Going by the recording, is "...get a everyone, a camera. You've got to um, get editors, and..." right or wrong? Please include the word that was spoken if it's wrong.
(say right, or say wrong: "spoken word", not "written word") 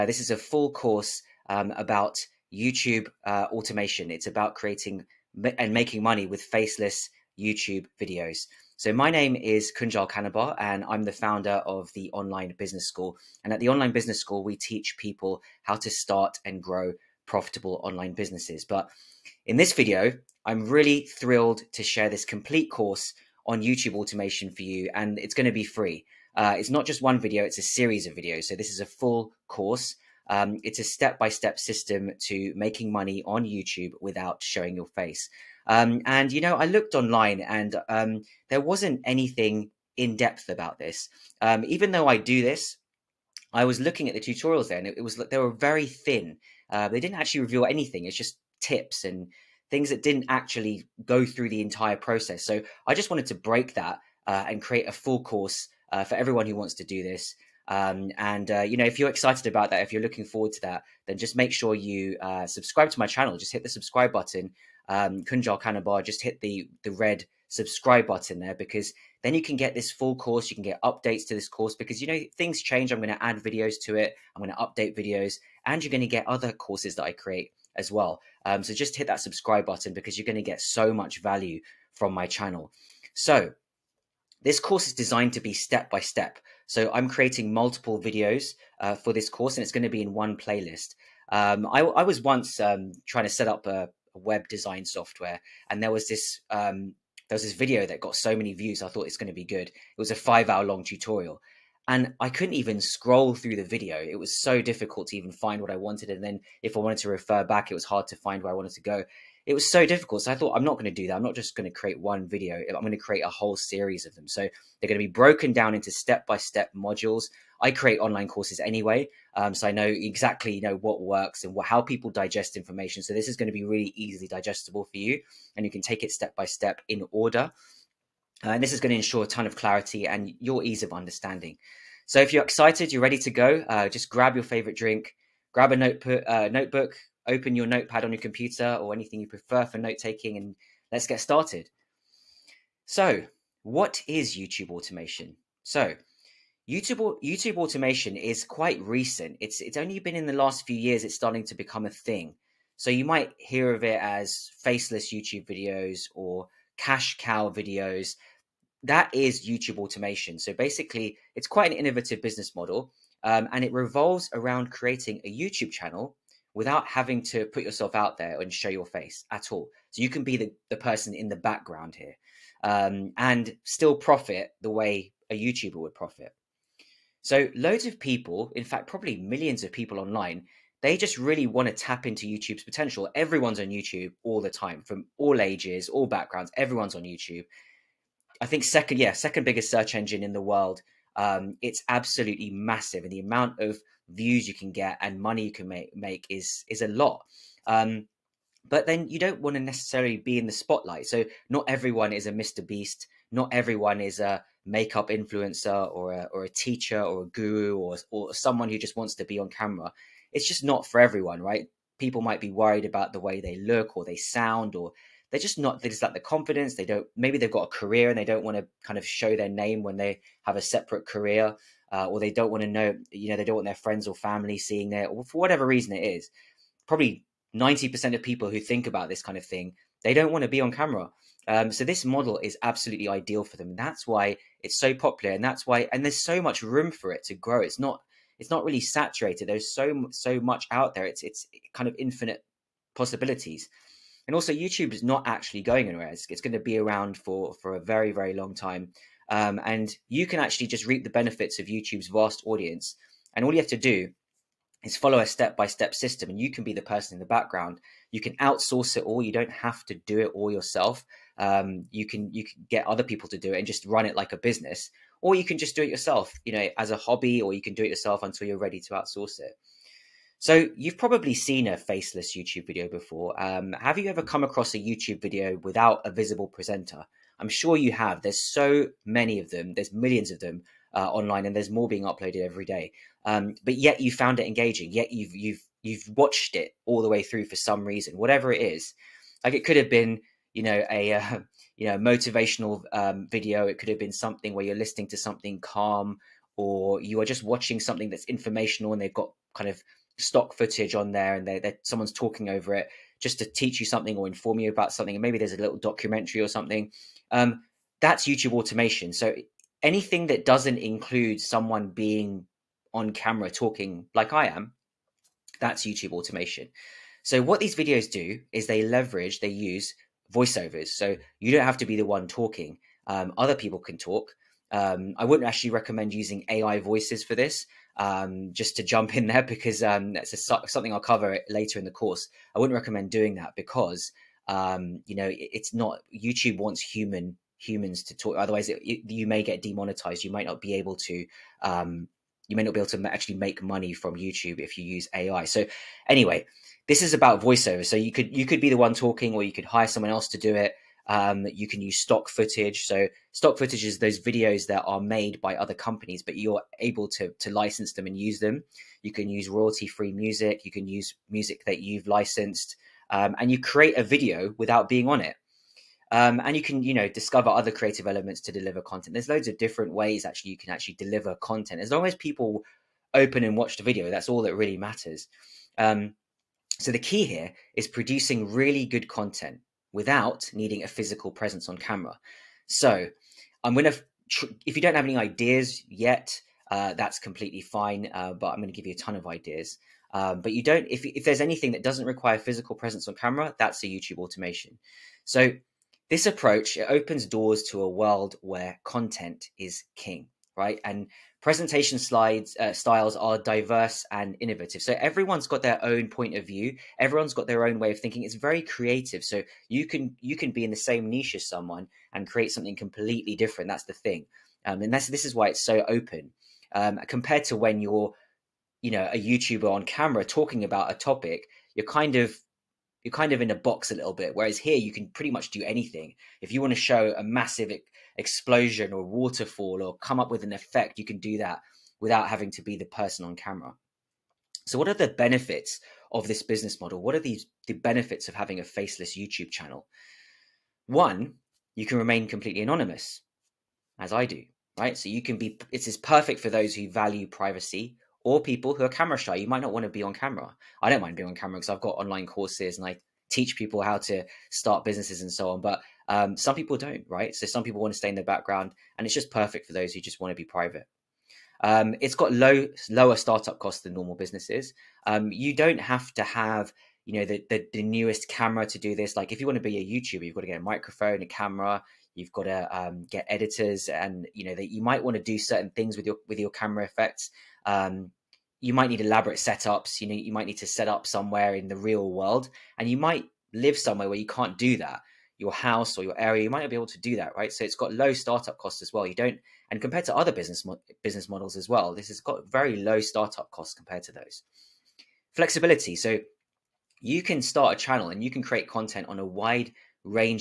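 wrong: "microphone", not "everyone".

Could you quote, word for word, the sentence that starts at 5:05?
And maybe there's a little documentary or something.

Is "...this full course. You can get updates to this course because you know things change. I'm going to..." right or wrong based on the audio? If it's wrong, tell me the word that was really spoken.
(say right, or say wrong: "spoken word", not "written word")
right.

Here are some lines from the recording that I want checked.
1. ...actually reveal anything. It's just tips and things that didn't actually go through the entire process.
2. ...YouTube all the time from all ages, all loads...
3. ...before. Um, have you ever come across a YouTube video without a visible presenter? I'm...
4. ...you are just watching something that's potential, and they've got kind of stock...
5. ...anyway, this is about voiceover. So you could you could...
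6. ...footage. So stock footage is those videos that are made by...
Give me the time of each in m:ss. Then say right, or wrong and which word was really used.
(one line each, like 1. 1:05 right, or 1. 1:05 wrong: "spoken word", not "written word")
1. 0:47 right
2. 3:03 wrong: "backgrounds", not "loads"
3. 4:32 right
4. 4:57 wrong: "informational", not "potential"
5. 5:46 right
6. 5:52 right.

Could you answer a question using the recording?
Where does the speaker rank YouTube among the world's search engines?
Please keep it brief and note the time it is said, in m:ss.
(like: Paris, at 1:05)
second biggest, at 3:09.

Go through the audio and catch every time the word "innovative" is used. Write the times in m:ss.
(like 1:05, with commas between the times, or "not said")
2:41, 6:44.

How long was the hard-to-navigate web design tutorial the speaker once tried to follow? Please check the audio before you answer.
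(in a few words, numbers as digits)
5 hours.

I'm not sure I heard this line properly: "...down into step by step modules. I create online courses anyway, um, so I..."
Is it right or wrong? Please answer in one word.
right.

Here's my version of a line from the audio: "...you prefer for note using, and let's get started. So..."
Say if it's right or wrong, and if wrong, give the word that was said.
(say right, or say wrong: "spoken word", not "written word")
wrong: "taking", not "using".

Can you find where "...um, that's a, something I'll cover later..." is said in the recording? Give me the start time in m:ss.
5:29.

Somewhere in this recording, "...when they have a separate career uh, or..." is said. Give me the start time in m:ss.
3:39.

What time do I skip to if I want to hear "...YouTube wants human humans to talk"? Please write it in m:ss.
5:36.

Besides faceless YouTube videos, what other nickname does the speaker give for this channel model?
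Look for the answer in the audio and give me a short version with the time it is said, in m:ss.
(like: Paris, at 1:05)
cash cow videos, at 2:36.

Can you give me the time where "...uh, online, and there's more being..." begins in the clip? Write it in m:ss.
4:40.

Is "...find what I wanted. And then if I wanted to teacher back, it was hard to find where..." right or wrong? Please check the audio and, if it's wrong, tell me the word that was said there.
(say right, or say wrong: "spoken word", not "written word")
wrong: "refer", not "teacher".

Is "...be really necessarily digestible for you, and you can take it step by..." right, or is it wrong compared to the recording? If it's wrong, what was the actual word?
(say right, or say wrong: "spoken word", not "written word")
wrong: "easily", not "necessarily".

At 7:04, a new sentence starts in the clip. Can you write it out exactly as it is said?
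Whereas here, you can pretty much do anything.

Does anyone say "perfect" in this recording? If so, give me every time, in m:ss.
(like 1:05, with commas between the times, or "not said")
7:25, 7:39.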